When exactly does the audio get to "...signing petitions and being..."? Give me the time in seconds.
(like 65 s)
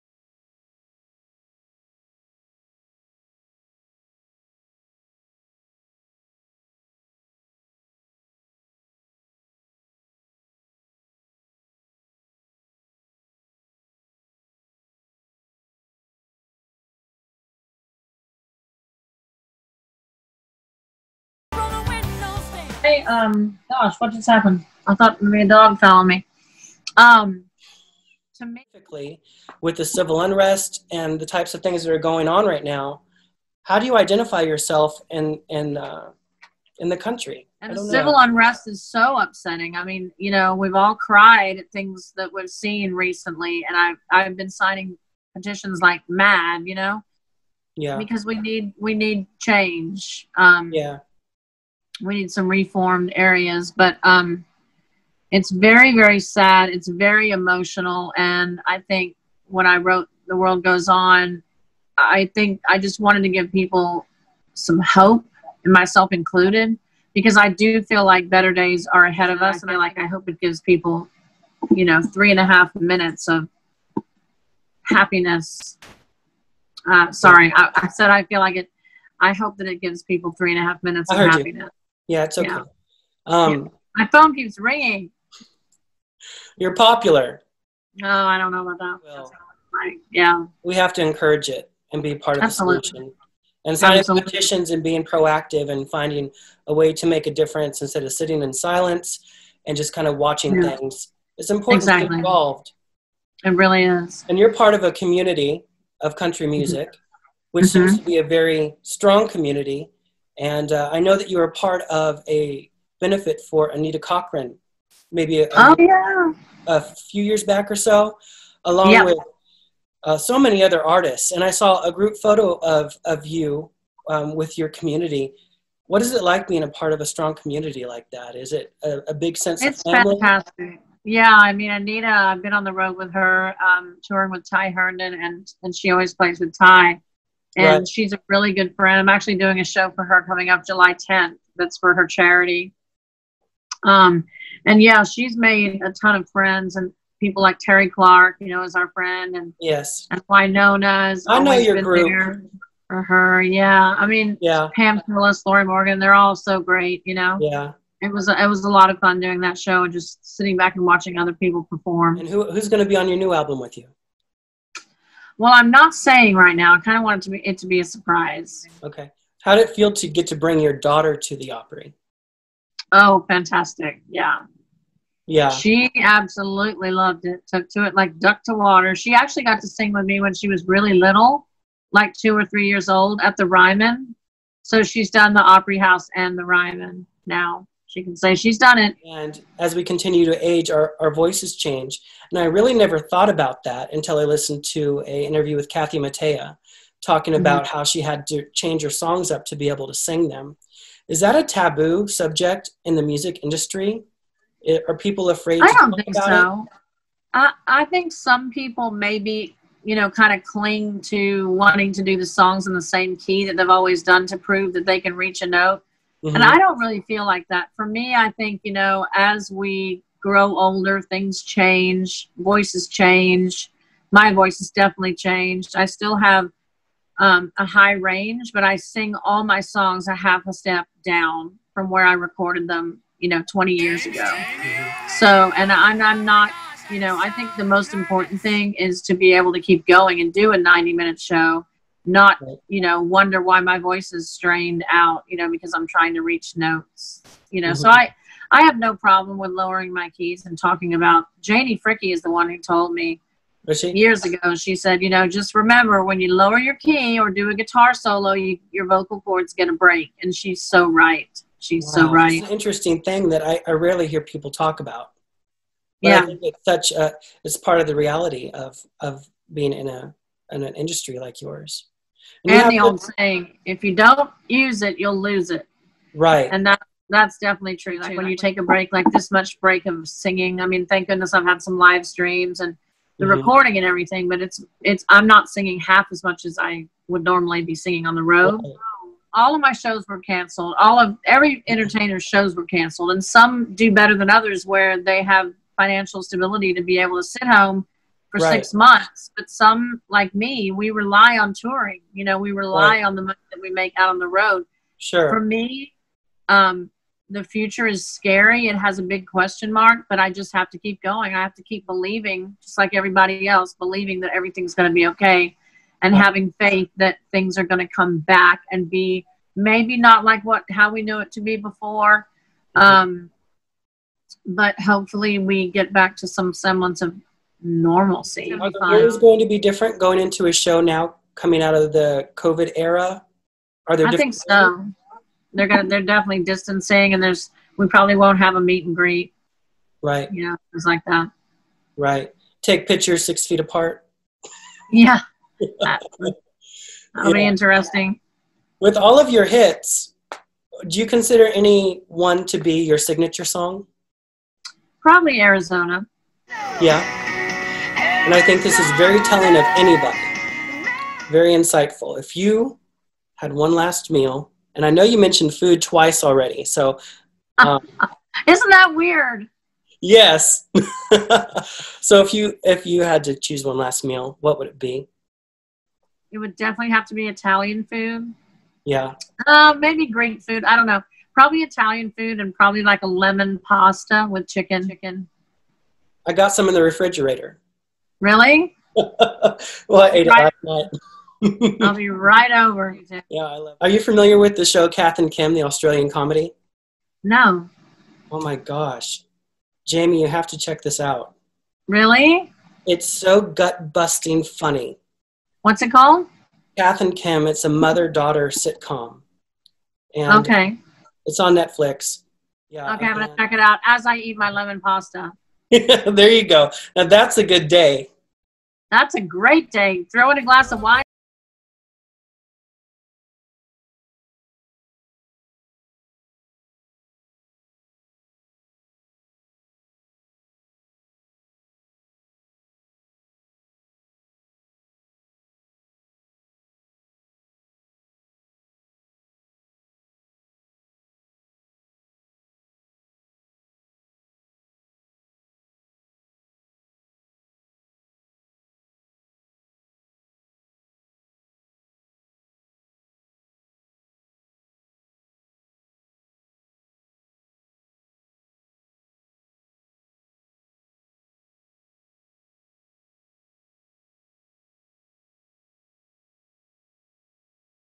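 93 s.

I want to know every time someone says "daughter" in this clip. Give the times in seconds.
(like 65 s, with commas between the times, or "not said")
170 s, 408 s.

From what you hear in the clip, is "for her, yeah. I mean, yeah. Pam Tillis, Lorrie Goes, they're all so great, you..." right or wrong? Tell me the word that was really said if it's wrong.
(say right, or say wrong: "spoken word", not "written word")
wrong: "Morgan", not "Goes".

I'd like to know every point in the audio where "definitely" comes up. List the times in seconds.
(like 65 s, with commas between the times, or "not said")
224 s, 277 s, 336 s, 376 s.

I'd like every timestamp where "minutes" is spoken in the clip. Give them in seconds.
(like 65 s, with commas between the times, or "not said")
72 s, 80 s, 240 s.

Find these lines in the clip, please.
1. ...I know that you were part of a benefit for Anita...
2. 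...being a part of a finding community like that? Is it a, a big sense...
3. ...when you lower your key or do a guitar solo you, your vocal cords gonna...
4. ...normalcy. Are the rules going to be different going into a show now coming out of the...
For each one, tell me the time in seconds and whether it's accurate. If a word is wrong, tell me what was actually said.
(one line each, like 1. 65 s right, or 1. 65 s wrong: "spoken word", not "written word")
1. 110 s right
2. 126 s wrong: "strong", not "finding"
3. 256 s right
4. 327 s right.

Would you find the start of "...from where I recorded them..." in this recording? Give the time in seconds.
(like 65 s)
231 s.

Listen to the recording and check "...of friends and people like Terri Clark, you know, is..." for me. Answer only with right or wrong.
right.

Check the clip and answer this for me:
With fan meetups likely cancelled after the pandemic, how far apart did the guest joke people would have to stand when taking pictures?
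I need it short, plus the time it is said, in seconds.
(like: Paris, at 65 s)
6 feet, at 343 s.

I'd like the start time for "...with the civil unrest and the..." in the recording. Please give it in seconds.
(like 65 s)
29 s.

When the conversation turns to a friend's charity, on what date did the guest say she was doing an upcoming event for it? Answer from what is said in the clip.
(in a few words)
July 10.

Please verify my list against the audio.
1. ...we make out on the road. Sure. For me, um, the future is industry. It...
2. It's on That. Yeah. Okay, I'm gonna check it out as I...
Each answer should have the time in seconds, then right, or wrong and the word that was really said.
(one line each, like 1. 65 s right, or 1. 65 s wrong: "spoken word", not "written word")
1. 303 s wrong: "scary", not "industry"
2. 411 s wrong: "Netflix", not "That".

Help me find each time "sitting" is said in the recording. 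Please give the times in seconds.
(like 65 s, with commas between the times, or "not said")
98 s, 160 s.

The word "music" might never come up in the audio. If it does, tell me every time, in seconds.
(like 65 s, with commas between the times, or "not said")
106 s, 203 s.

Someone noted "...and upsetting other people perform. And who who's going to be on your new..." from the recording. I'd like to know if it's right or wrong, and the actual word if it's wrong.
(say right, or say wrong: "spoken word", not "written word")
wrong: "watching", not "upsetting".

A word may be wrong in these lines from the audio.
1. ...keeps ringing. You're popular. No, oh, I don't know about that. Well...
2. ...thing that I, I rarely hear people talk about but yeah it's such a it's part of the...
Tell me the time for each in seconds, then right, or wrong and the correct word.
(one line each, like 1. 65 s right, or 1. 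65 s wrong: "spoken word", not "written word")
1. 84 s right
2. 263 s right.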